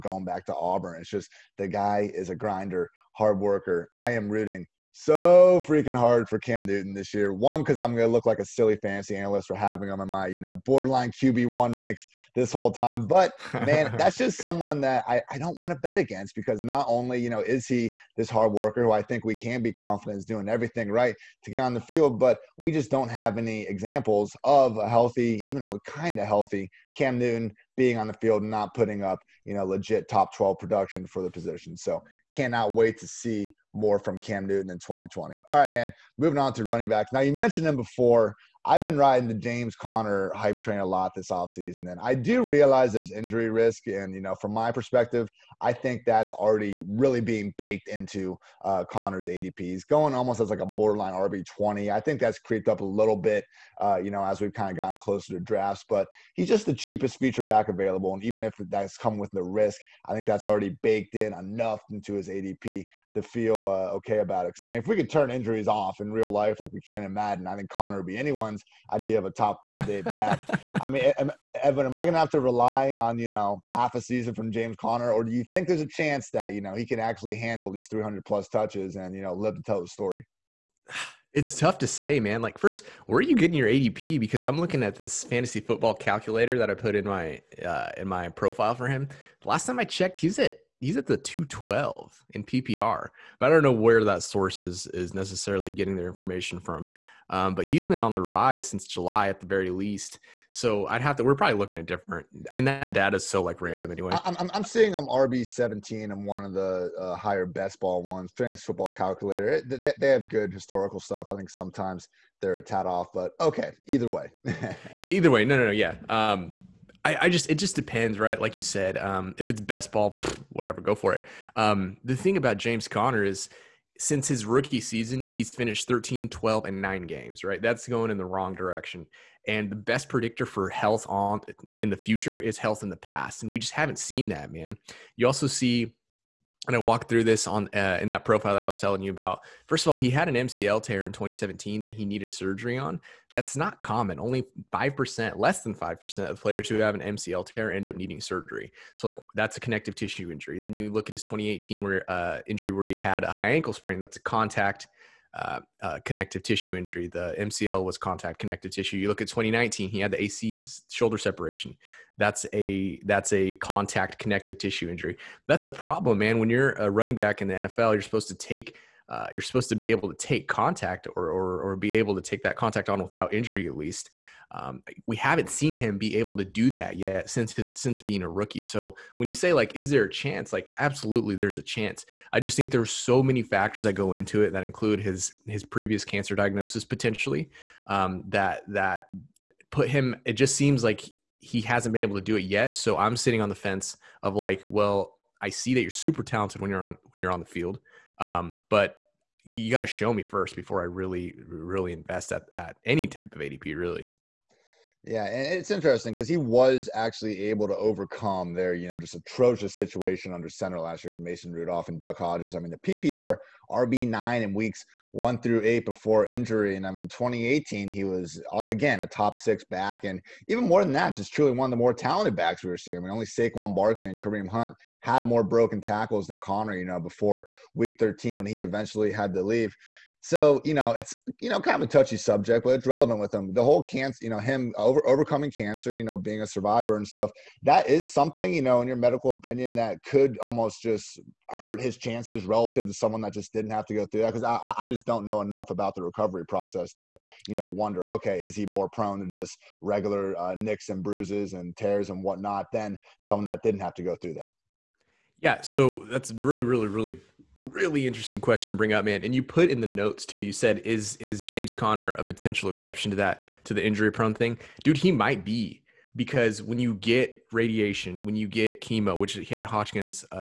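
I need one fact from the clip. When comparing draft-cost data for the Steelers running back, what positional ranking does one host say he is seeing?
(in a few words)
RB17.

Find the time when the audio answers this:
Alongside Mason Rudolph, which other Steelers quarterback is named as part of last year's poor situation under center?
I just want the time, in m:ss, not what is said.
3:31.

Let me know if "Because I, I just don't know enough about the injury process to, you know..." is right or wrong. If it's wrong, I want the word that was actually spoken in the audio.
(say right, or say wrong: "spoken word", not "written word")
wrong: "recovery", not "injury".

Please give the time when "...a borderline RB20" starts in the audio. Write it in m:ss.
0:50.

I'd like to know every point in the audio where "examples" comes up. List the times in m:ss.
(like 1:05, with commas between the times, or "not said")
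0:23.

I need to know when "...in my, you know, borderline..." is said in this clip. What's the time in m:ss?
0:10.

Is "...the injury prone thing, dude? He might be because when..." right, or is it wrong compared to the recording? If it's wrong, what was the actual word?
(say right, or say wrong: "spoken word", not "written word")
right.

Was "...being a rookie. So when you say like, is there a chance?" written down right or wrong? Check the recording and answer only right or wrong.
right.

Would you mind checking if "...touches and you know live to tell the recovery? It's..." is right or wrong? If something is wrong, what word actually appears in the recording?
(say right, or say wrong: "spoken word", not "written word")
wrong: "story", not "recovery".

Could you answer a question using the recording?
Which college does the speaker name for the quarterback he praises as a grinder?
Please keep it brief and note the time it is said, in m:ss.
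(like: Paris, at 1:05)
Auburn, at 0:00.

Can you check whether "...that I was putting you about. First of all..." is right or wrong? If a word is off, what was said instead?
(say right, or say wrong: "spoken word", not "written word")
wrong: "telling", not "putting".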